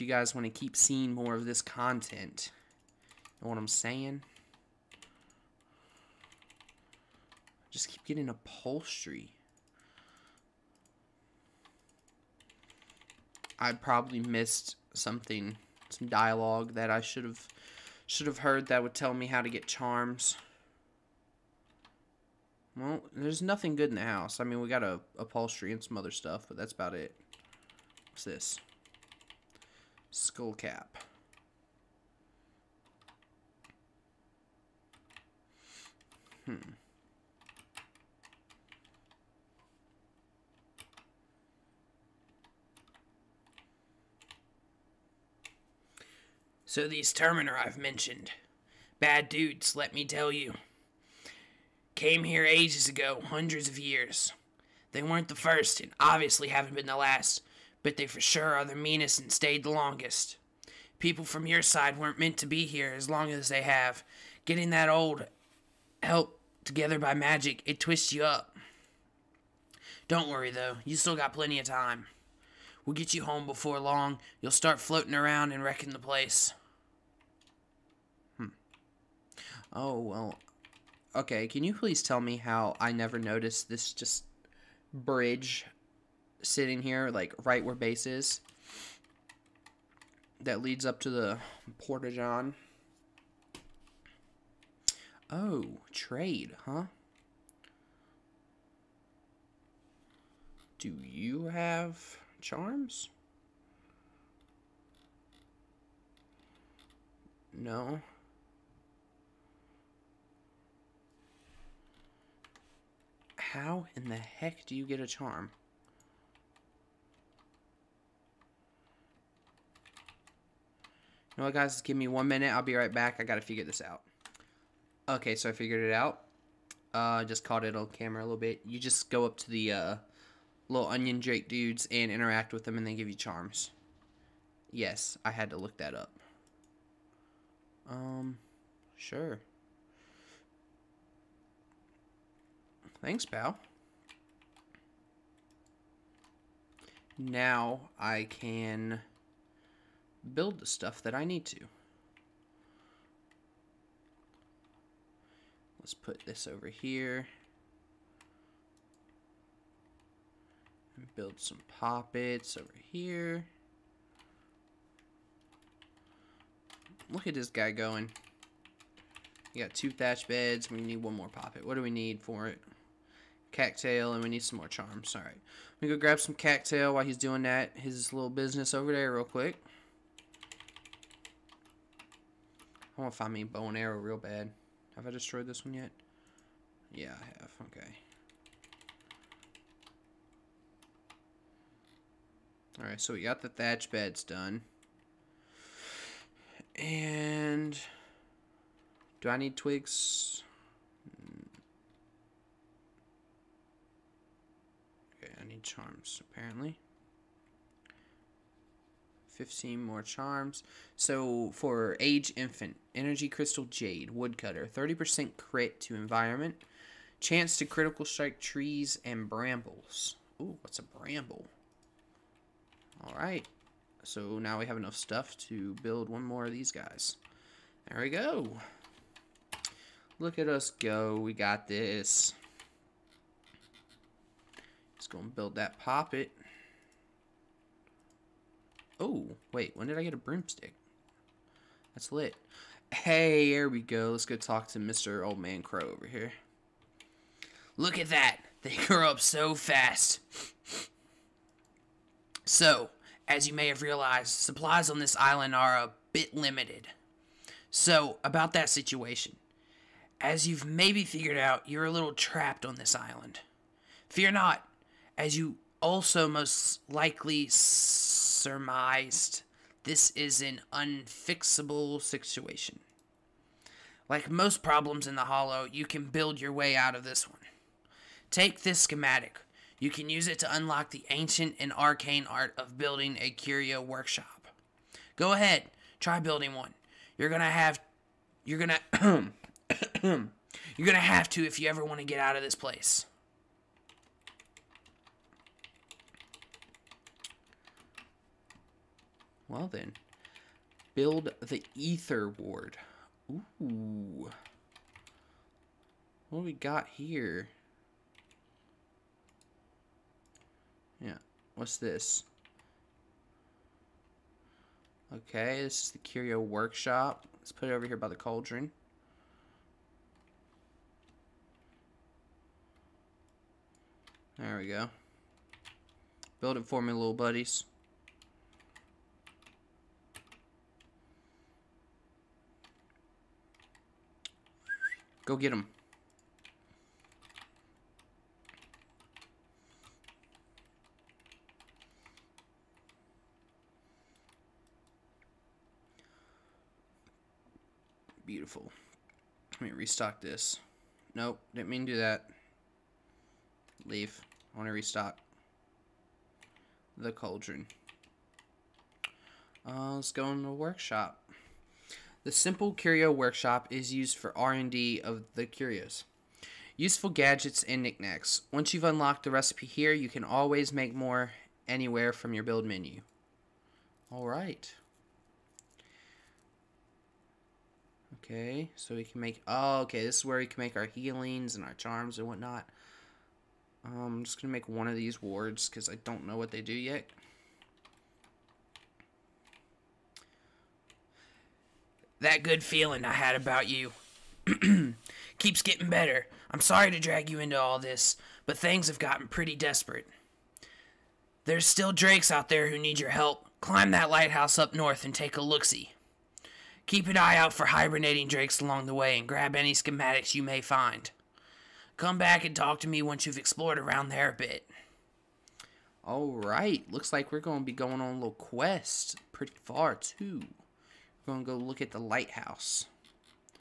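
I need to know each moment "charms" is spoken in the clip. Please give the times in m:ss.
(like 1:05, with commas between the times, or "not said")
0:19, 1:42, 1:55, 2:13, 2:54, 3:25, 3:30, 6:21.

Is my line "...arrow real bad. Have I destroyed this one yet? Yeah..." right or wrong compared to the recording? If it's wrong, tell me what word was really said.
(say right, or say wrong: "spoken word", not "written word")
right.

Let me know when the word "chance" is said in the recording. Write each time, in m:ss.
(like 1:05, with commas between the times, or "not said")
3:37.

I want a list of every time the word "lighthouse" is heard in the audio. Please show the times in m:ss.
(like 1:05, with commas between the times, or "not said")
6:44, 7:01.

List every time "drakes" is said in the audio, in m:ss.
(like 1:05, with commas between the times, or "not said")
2:11, 6:41, 6:48.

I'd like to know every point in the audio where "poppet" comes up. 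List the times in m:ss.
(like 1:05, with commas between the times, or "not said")
2:41, 2:51, 3:55.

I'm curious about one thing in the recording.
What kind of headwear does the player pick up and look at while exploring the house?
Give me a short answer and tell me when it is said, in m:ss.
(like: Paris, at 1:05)
Skull cap, at 0:30.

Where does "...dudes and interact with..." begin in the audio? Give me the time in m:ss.
2:11.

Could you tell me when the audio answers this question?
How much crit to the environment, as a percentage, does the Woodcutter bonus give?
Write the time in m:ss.
3:34.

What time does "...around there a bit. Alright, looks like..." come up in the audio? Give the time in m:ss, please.
6:53.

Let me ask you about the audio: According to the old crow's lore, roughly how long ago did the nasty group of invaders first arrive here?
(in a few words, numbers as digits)
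Hundreds of years.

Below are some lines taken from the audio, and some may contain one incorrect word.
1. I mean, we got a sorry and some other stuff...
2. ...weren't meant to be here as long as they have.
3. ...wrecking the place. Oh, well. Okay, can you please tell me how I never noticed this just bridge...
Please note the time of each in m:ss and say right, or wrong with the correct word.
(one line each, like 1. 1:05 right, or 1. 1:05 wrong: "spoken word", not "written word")
1. 0:24 wrong: "upholstery", not "sorry"
2. 1:01 right
3. 1:15 right.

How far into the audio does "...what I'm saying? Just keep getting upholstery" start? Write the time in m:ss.
0:03.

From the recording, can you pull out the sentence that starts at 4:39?
You can use it to unlock the ancient and arcane art of building a curio workshop.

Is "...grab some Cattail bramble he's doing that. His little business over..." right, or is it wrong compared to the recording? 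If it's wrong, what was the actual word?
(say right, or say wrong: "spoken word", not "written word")
wrong: "while", not "bramble".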